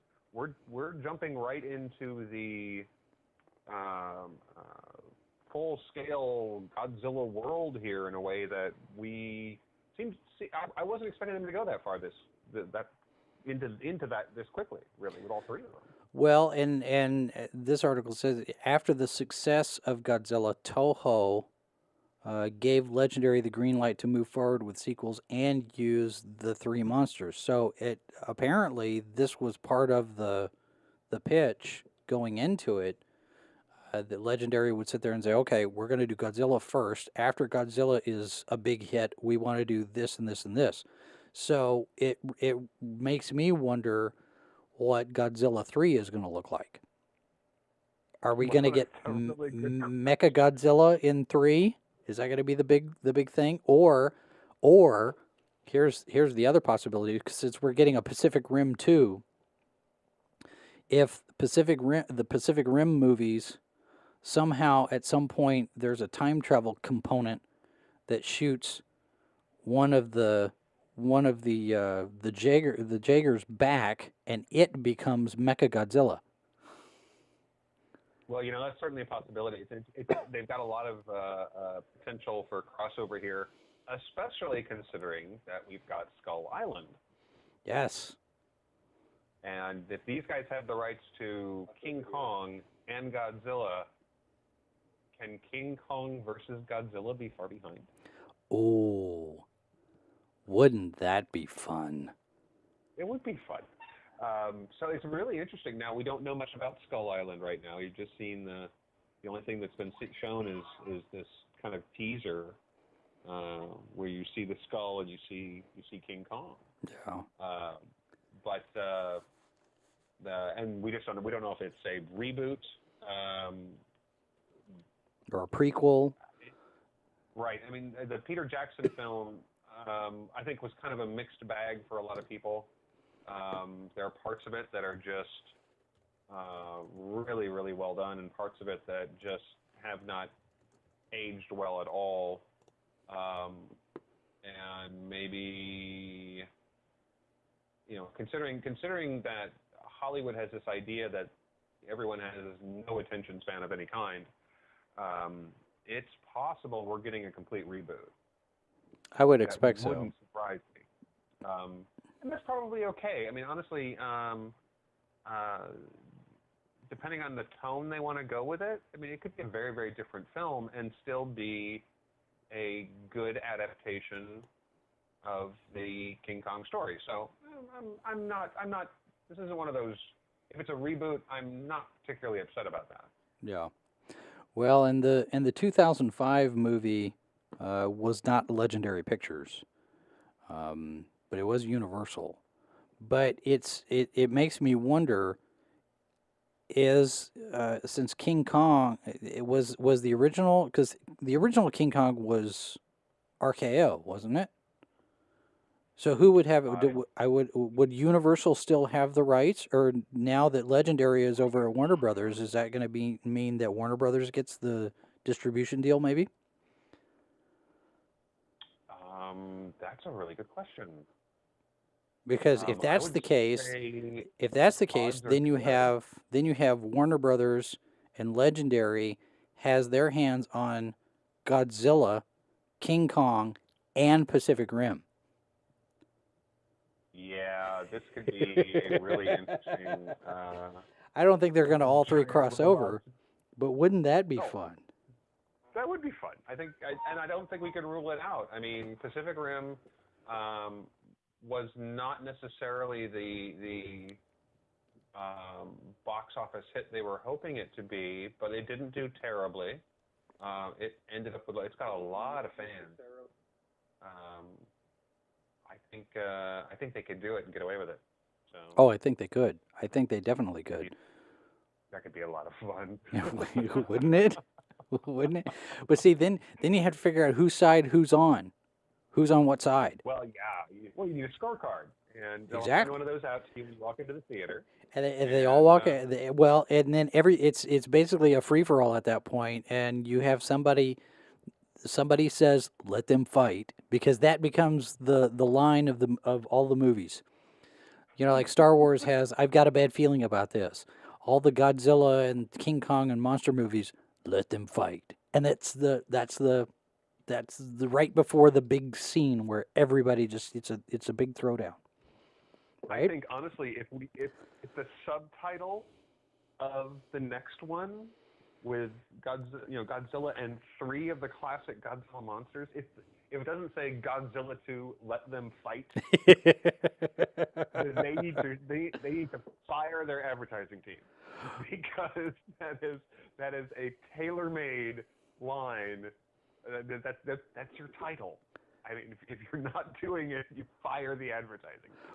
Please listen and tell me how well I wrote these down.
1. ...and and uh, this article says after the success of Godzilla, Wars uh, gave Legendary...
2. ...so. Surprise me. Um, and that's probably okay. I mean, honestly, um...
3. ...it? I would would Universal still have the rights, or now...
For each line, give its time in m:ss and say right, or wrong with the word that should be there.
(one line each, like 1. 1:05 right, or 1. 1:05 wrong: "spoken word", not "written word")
1. 0:16 wrong: "Toho", not "Wars"
2. 2:40 right
3. 3:26 right.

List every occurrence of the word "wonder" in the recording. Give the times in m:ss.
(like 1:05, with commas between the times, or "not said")
0:43, 3:14.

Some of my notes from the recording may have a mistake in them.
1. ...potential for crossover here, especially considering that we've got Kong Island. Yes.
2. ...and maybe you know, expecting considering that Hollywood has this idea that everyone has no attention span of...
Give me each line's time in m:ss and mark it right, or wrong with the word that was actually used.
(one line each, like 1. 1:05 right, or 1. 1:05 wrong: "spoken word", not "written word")
1. 1:21 wrong: "Skull", not "Kong"
2. 2:24 wrong: "considering", not "expecting".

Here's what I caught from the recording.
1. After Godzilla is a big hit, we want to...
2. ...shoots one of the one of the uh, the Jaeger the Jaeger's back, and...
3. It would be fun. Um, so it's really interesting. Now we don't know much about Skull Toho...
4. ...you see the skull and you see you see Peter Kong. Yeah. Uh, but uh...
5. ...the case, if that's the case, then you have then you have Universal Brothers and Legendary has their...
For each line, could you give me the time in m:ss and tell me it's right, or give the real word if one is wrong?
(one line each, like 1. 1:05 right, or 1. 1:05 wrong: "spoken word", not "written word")
1. 0:37 right
2. 1:08 right
3. 1:42 wrong: "Island", not "Toho"
4. 1:54 wrong: "King", not "Peter"
5. 3:43 wrong: "Warner", not "Universal".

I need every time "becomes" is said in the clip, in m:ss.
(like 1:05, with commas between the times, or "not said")
1:14, 4:54.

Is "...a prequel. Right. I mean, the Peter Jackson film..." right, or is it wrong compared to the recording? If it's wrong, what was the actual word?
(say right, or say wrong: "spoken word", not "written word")
right.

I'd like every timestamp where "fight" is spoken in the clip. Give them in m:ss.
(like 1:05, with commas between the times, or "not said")
4:53, 5:04, 5:25.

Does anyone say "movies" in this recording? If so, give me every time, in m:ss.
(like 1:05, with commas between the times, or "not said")
1:02, 3:06, 4:56, 5:03.